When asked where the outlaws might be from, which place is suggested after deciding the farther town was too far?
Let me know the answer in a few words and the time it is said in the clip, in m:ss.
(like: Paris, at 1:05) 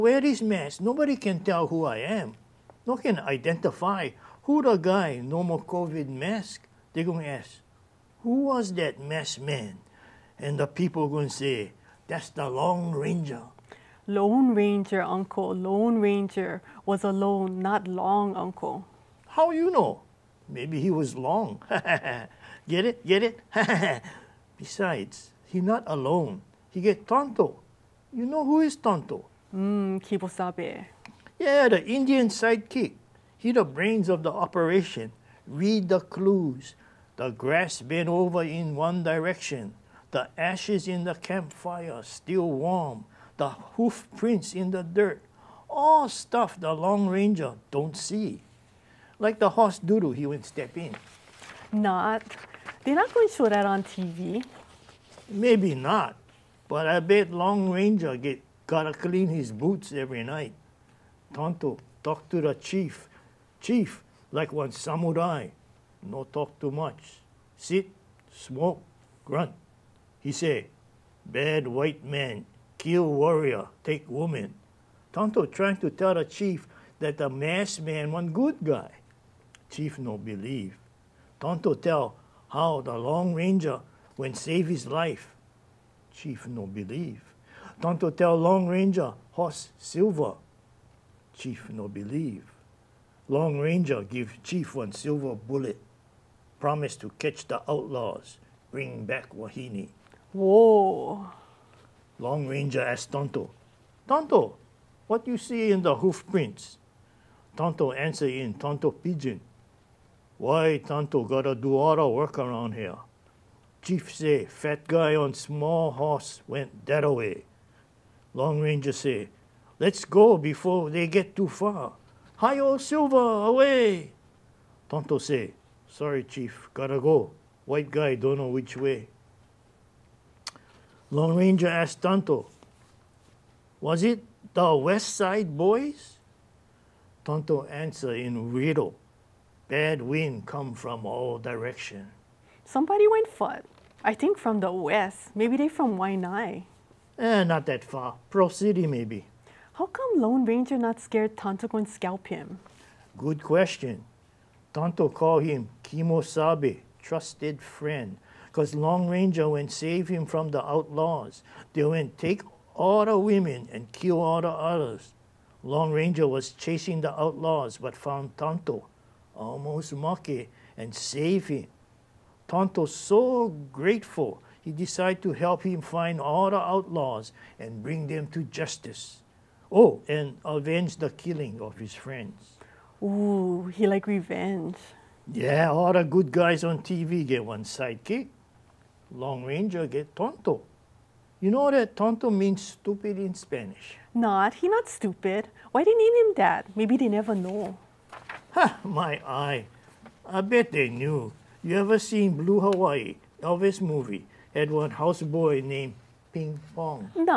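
Pearl City, at 2:28.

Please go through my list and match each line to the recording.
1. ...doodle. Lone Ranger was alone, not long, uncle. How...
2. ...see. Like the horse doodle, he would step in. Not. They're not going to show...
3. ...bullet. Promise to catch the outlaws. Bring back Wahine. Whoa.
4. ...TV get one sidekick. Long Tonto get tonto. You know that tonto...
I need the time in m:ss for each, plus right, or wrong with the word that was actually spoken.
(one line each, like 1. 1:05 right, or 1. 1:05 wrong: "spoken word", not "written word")
1. 0:15 wrong: "uncle", not "doodle"
2. 0:47 right
3. 1:35 right
4. 3:06 wrong: "Ranger", not "Tonto".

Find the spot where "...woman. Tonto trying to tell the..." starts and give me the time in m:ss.
1:14.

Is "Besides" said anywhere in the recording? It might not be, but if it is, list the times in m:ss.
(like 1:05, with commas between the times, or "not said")
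0:24.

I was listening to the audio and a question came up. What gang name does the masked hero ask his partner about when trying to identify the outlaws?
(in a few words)
West Side Boys.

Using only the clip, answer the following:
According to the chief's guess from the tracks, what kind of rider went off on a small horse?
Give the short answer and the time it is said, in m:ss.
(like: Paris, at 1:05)
fat guy, at 1:54.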